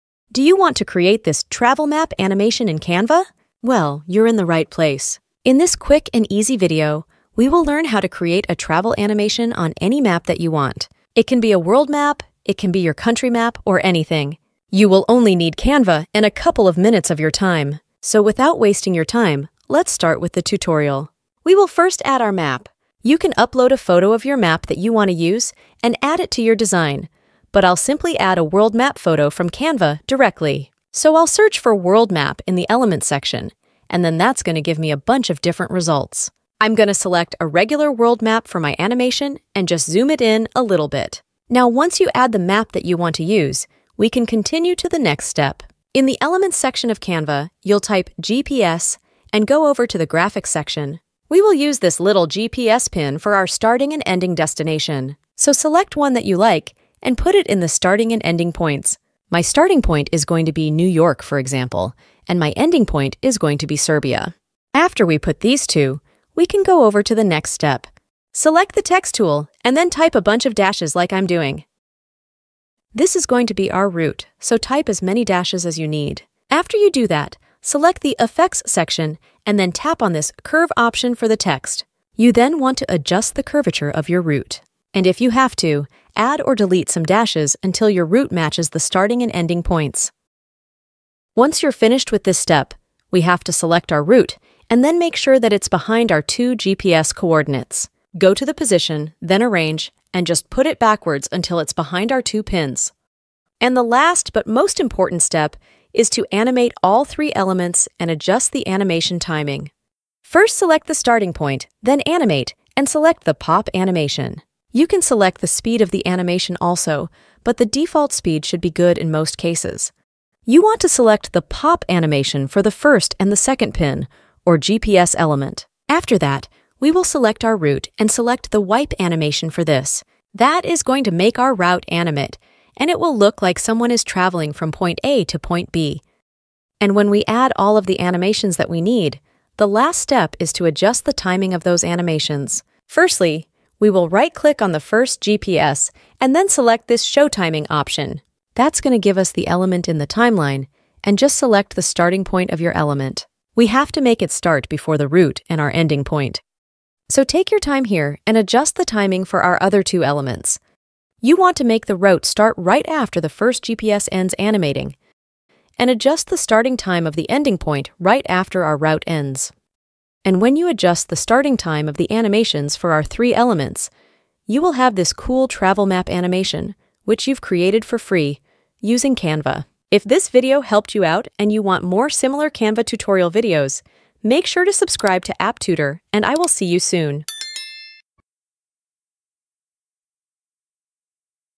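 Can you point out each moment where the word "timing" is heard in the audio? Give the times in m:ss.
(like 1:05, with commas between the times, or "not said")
1:49, 2:21, 2:27, 2:38.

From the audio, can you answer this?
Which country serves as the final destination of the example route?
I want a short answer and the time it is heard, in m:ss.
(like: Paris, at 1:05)
Serbia, at 1:03.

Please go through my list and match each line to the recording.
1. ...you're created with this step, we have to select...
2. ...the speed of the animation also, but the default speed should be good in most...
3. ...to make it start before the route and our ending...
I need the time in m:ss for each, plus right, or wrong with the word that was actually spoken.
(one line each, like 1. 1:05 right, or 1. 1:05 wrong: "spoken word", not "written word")
1. 1:31 wrong: "finished", not "created"
2. 1:55 right
3. 2:33 right.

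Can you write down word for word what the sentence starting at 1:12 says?
This is going to be our route, so type as many dashes as you need.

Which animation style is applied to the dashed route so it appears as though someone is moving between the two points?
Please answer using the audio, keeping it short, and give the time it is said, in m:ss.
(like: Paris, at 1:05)
wipe, at 2:08.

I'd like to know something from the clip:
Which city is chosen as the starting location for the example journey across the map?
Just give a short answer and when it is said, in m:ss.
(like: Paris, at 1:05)
New York, at 1:00.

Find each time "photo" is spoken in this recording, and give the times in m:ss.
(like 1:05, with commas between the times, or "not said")
0:23, 0:28.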